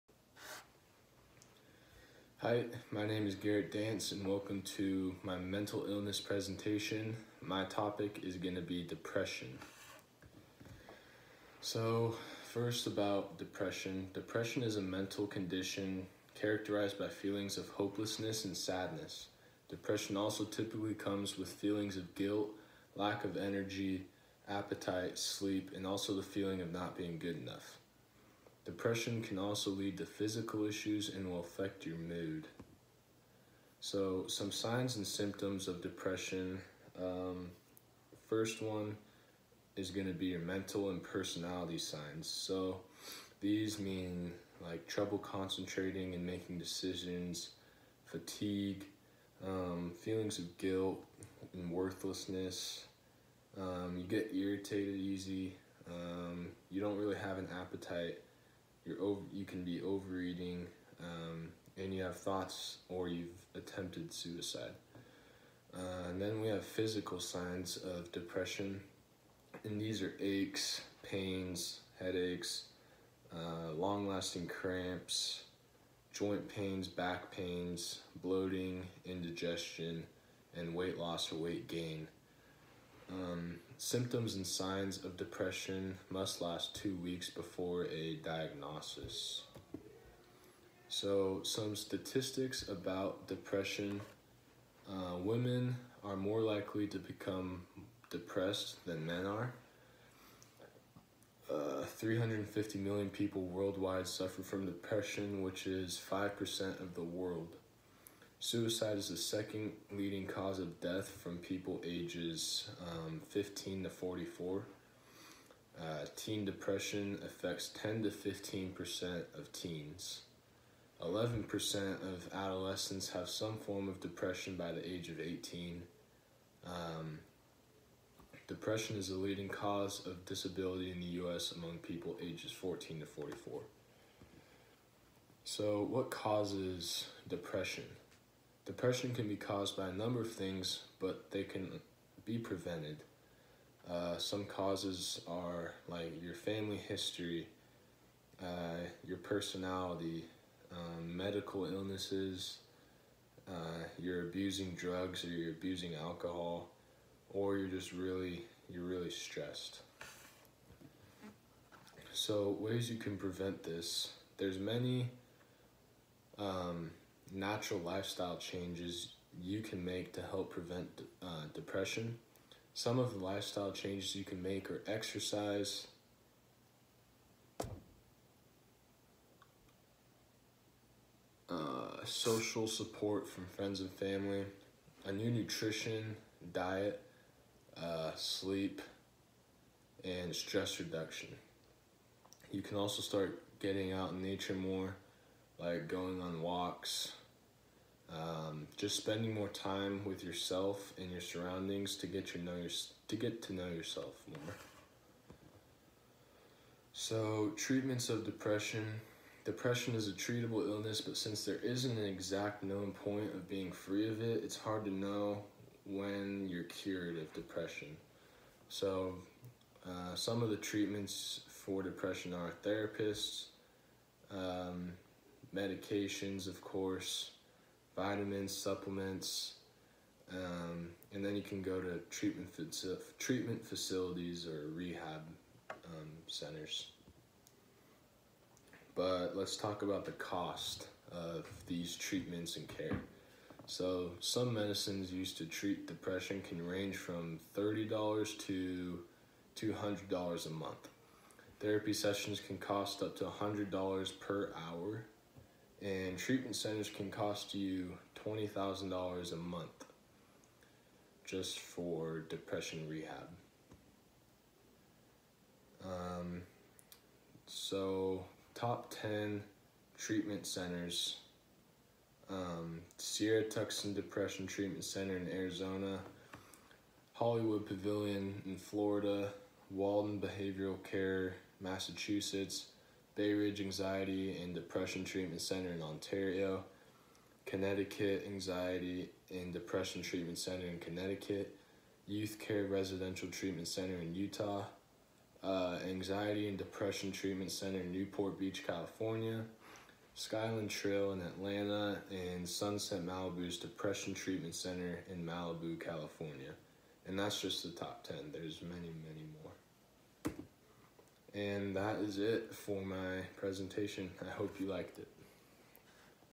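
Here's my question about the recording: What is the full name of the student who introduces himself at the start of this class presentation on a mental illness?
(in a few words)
Garrett Dance.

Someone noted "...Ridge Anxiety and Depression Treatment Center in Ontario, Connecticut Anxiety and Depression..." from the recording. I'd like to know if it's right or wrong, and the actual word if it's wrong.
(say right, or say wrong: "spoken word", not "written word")
right.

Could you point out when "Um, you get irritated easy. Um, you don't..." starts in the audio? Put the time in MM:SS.
00:53.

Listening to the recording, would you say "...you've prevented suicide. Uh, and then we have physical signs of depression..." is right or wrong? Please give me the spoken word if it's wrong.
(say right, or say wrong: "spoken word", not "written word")
wrong: "attempted", not "prevented".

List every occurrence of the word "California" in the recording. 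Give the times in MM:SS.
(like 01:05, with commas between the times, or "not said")
04:58, 05:05.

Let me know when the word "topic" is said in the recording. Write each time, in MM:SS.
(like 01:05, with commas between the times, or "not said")
00:07.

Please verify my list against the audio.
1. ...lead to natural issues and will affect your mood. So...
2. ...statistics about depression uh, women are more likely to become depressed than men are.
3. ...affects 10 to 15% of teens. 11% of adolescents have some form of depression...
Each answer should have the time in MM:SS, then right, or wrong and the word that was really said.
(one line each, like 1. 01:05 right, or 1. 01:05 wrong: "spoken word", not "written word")
1. 00:29 wrong: "physical", not "natural"
2. 01:31 right
3. 01:57 right.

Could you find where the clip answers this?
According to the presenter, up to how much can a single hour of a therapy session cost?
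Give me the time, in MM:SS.
04:13.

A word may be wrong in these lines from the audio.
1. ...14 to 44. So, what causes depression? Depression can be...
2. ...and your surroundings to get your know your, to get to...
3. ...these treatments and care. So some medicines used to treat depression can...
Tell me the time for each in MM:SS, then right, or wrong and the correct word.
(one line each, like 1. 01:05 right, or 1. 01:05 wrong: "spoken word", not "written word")
1. 02:12 right
2. 03:20 right
3. 04:01 right.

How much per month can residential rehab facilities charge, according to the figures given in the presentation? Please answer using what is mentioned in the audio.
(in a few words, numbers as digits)
$20,000.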